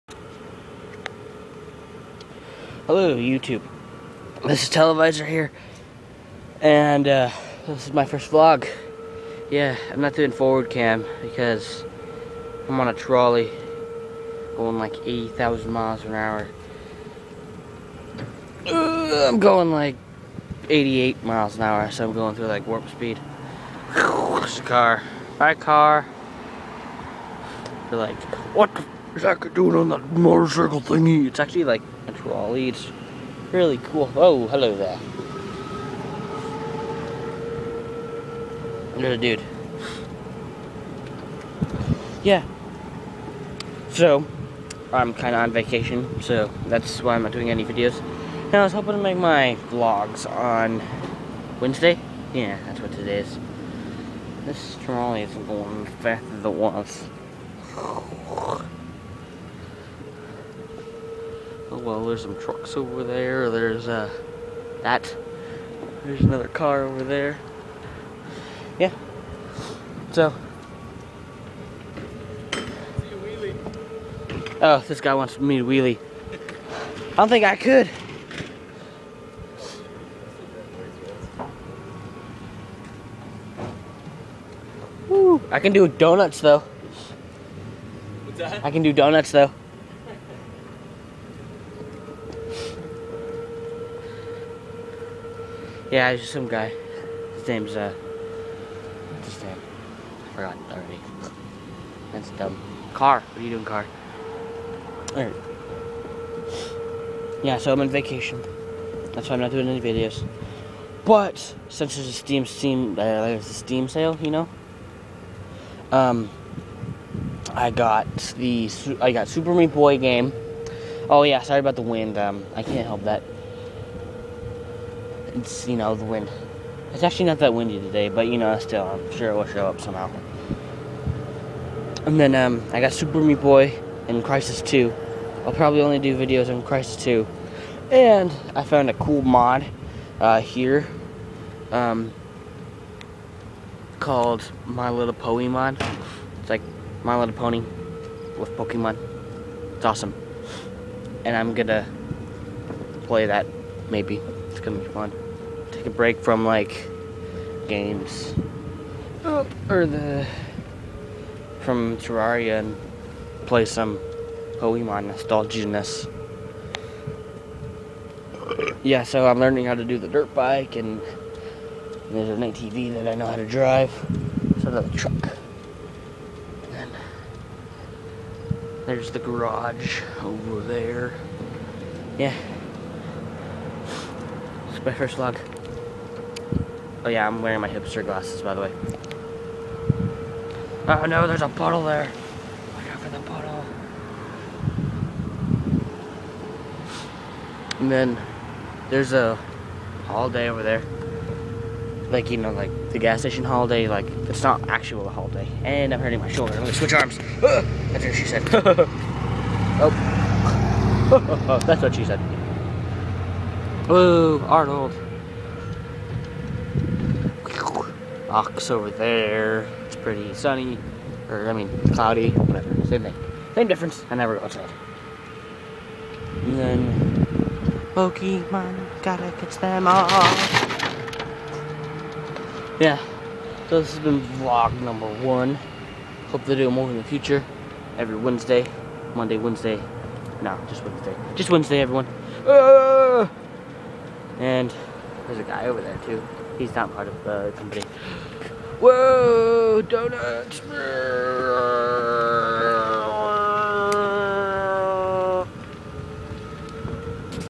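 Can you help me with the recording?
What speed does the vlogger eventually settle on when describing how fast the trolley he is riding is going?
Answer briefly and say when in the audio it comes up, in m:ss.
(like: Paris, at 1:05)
88 miles an hour, at 0:20.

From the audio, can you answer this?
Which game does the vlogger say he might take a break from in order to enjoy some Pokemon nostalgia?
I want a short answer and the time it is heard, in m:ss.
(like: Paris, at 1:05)
Terraria, at 2:41.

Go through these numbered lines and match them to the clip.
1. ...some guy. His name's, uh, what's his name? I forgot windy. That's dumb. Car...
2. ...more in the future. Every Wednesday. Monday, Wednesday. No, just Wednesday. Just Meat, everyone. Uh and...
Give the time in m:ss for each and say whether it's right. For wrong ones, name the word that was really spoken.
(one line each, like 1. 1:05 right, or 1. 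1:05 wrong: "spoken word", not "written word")
1. 1:36 wrong: "already", not "windy"
2. 3:56 wrong: "Wednesday", not "Meat".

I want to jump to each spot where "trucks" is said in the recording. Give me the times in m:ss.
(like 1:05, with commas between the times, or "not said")
1:02, 2:54.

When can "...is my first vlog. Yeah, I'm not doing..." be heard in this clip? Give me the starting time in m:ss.
0:07.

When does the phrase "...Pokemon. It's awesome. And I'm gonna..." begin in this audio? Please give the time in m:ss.
2:28.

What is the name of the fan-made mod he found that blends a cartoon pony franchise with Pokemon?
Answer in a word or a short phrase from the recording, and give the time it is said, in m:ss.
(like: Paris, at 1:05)
My Little Pony Mod, at 2:24.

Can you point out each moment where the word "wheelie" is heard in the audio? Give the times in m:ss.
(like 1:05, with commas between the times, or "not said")
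1:15.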